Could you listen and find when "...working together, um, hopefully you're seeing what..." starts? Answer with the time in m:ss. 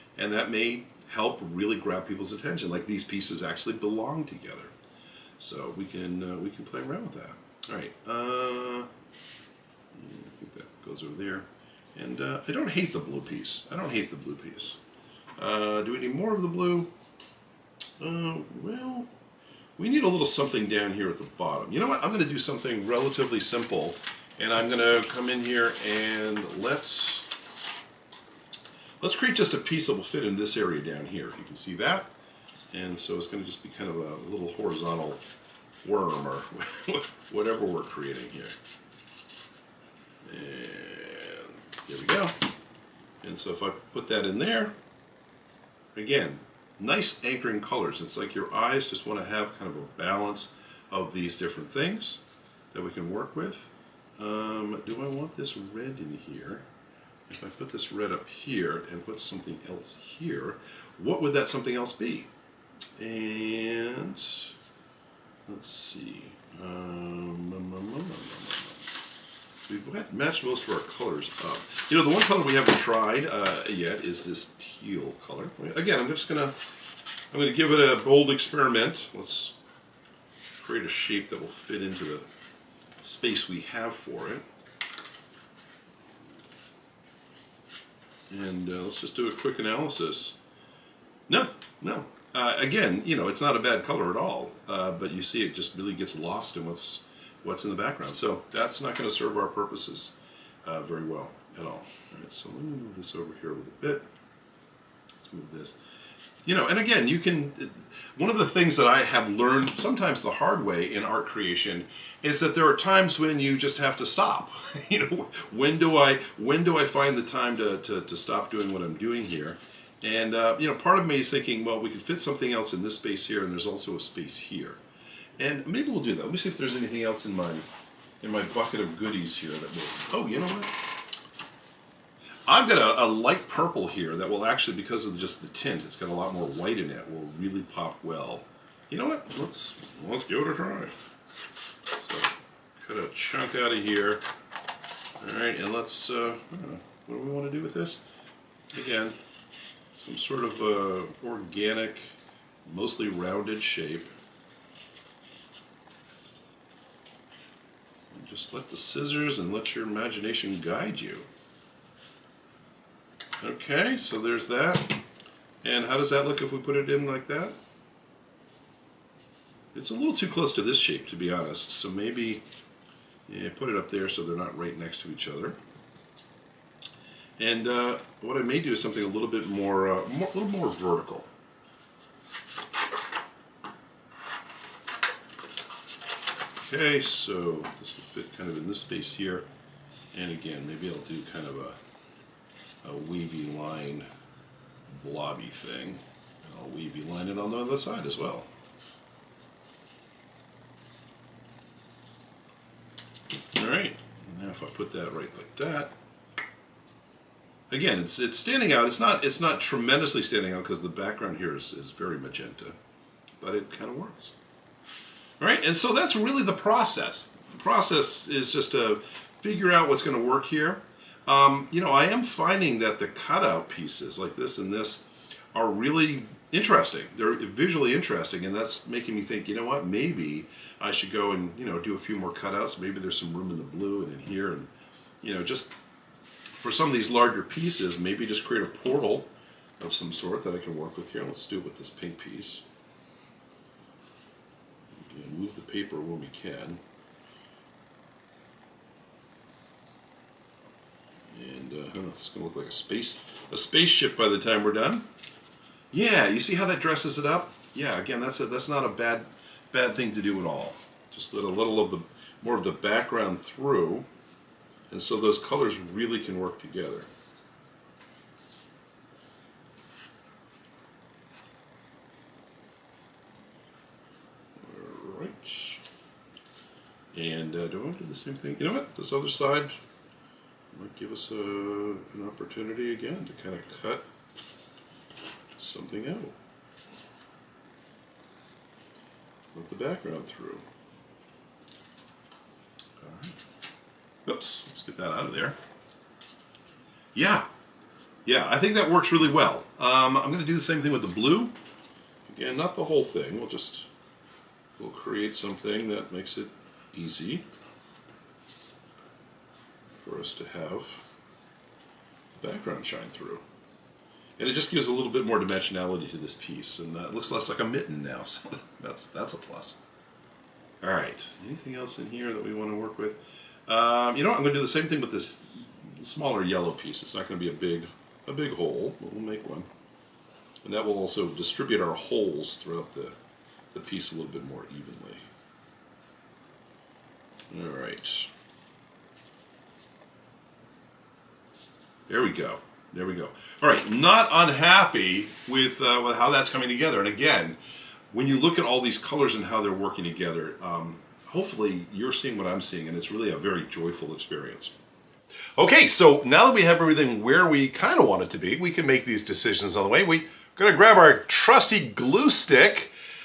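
5:49.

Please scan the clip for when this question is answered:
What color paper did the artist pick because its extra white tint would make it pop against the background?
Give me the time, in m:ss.
2:13.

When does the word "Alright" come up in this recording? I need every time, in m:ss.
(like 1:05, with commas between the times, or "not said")
3:23, 4:53, 5:20, 5:37.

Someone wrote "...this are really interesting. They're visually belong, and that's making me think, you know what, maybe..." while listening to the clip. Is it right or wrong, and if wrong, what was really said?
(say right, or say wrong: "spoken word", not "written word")
wrong: "interesting", not "belong".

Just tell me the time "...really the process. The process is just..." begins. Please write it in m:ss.
3:36.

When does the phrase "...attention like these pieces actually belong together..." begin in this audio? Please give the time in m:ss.
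0:02.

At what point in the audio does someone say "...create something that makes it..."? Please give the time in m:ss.
5:04.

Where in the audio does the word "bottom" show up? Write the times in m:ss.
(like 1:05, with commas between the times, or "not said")
0:21.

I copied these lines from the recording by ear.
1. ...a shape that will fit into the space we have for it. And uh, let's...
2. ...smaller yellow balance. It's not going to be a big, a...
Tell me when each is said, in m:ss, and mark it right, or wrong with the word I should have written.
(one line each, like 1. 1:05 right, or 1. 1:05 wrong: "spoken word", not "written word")
1. 1:20 right
2. 5:26 wrong: "piece", not "balance".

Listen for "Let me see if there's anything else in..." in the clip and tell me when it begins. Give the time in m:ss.
2:06.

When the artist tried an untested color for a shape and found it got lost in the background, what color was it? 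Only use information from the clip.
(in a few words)
teal.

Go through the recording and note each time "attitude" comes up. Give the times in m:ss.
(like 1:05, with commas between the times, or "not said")
not said.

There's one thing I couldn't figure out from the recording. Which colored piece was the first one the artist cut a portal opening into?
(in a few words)
pink.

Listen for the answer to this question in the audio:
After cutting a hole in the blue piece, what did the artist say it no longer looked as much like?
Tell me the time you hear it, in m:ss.
5:17.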